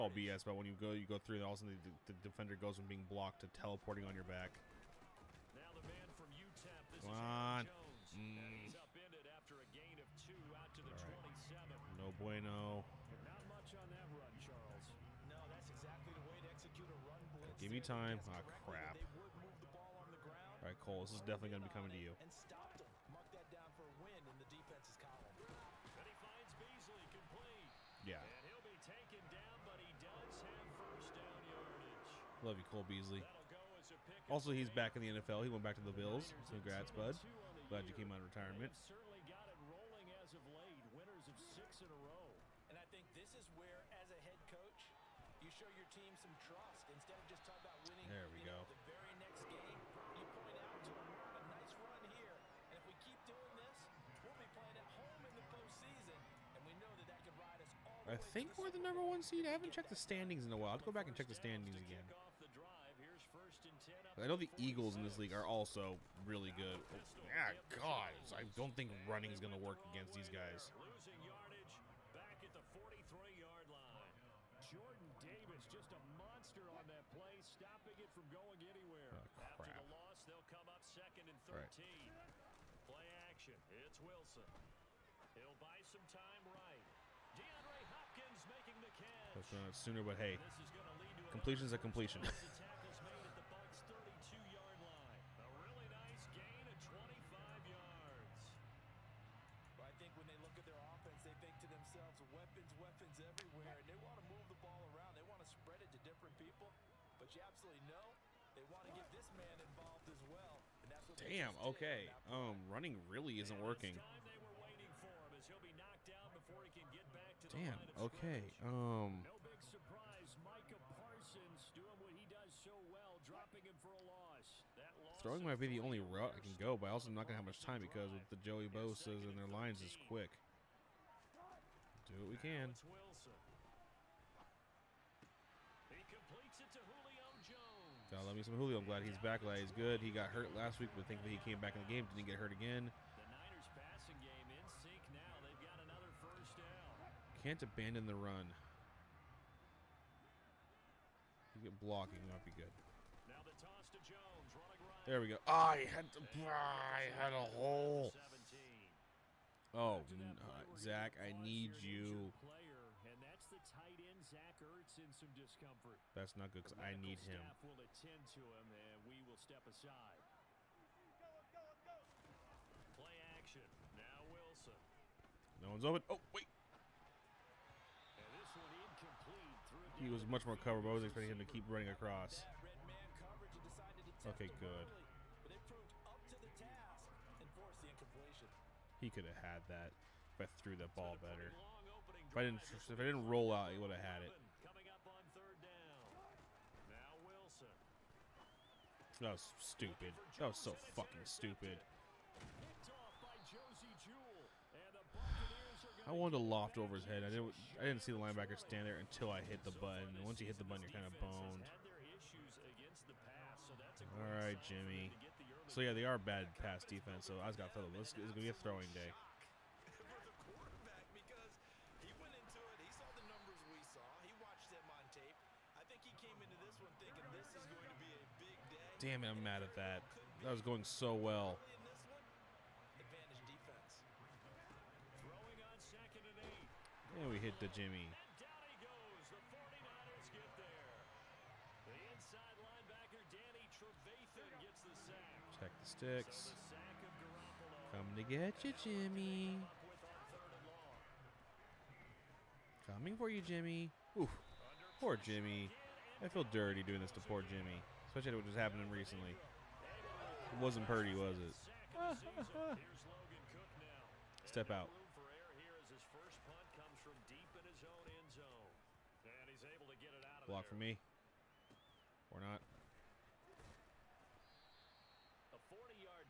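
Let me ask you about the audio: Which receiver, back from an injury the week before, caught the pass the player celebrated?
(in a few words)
Julio Jones.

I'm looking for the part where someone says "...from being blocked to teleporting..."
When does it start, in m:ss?
0:02.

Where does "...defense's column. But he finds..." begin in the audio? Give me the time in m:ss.
0:24.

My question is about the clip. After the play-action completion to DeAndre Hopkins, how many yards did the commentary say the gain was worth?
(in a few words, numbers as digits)
25.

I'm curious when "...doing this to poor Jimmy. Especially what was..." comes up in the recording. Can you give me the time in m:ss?
4:16.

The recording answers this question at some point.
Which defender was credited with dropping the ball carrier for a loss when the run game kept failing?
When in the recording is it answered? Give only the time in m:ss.
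2:00.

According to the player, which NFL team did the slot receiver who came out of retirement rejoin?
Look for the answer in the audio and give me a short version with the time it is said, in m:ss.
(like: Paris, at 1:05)
Bills, at 0:35.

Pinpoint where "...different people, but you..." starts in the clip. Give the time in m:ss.
1:46.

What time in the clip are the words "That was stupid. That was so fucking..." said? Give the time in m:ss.
3:19.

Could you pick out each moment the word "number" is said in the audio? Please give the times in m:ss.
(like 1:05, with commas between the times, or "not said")
0:58.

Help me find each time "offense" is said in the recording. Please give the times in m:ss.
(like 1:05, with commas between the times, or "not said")
1:40.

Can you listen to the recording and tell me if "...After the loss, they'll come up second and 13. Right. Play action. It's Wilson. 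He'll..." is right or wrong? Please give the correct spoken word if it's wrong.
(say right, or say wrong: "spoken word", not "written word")
right.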